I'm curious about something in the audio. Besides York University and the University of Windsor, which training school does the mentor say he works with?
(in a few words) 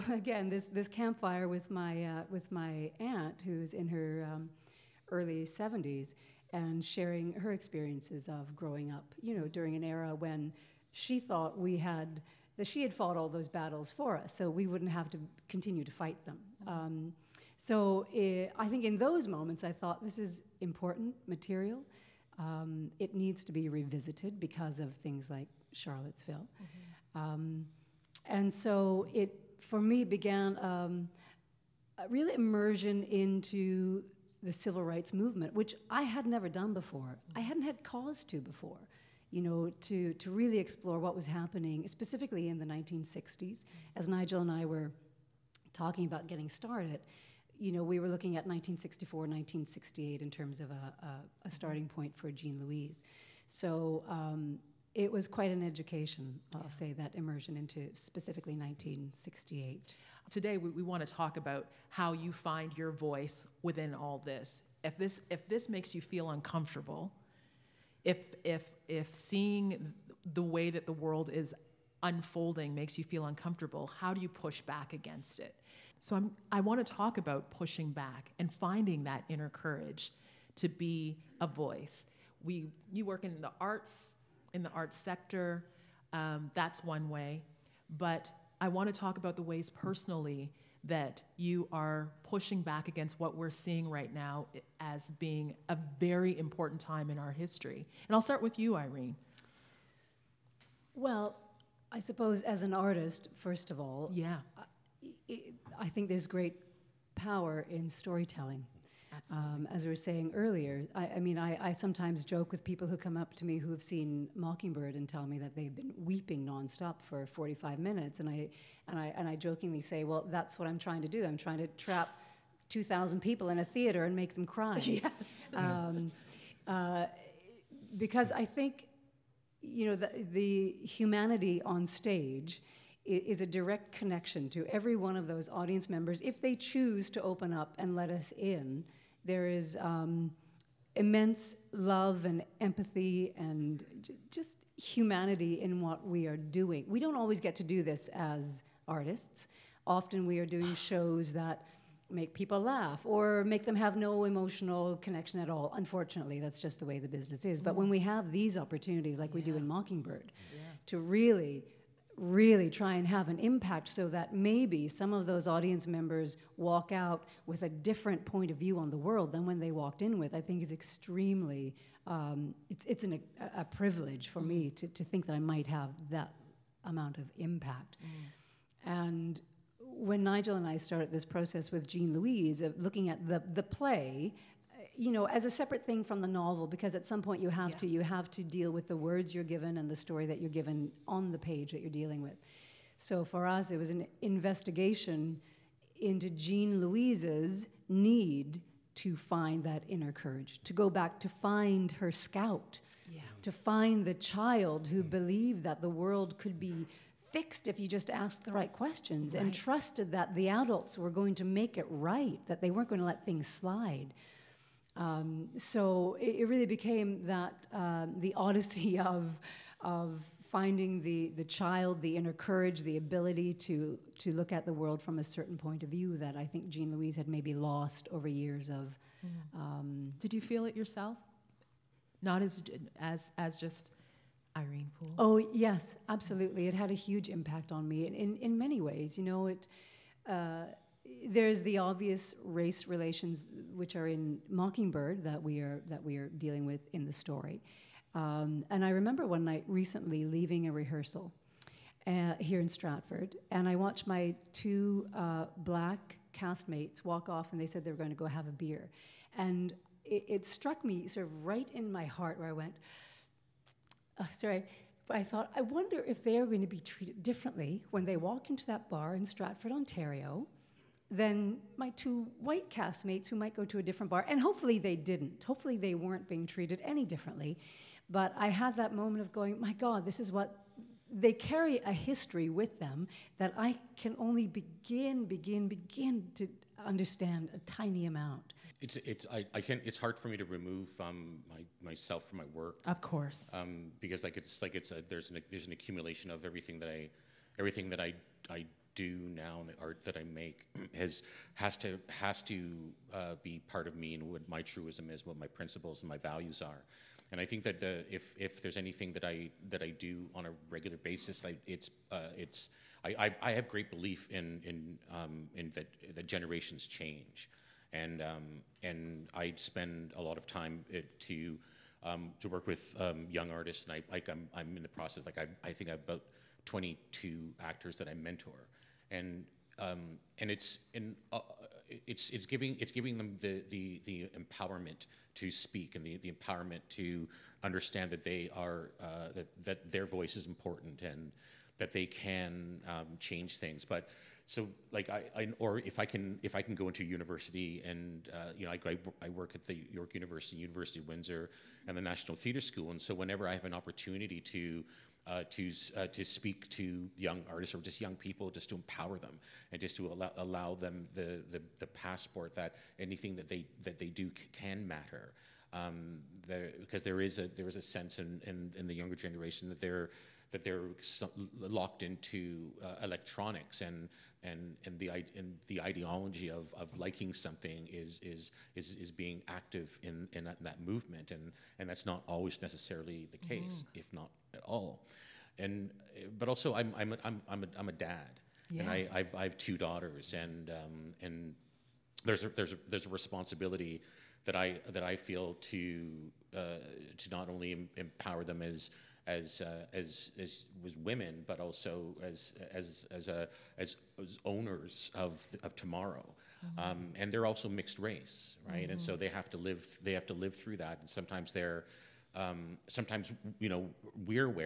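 National Theatre School.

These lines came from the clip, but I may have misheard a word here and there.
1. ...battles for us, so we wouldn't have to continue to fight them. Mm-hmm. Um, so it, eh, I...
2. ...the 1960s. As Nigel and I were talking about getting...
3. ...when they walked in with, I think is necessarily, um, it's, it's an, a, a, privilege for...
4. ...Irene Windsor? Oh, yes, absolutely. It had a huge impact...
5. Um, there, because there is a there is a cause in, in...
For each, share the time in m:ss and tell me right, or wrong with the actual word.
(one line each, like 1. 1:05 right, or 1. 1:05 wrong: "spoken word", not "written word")
1. 0:13 right
2. 0:42 right
3. 2:49 wrong: "extremely", not "necessarily"
4. 3:54 wrong: "Poole", not "Windsor"
5. 6:05 wrong: "sense", not "cause".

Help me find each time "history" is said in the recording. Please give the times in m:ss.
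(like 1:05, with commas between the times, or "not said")
1:37, 4:41.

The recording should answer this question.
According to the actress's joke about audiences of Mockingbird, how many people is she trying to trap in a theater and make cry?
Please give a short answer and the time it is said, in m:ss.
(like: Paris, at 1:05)
2,000, at 2:02.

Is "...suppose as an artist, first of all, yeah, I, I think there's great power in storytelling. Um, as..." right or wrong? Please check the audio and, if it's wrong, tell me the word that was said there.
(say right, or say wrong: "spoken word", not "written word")
right.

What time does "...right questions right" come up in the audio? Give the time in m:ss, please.
3:28.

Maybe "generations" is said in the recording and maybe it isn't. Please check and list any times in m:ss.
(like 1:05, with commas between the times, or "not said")
5:16, 6:09.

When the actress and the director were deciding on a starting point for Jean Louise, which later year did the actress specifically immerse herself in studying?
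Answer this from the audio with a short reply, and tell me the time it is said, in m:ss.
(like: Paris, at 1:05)
1968, at 0:57.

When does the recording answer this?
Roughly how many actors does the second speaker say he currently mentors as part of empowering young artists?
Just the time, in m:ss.
5:26.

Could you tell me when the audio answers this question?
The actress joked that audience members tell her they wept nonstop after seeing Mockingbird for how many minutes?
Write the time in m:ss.
1:57.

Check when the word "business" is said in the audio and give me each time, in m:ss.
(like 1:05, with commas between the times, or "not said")
2:37.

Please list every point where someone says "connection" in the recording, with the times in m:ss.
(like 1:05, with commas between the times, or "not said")
2:13, 2:34.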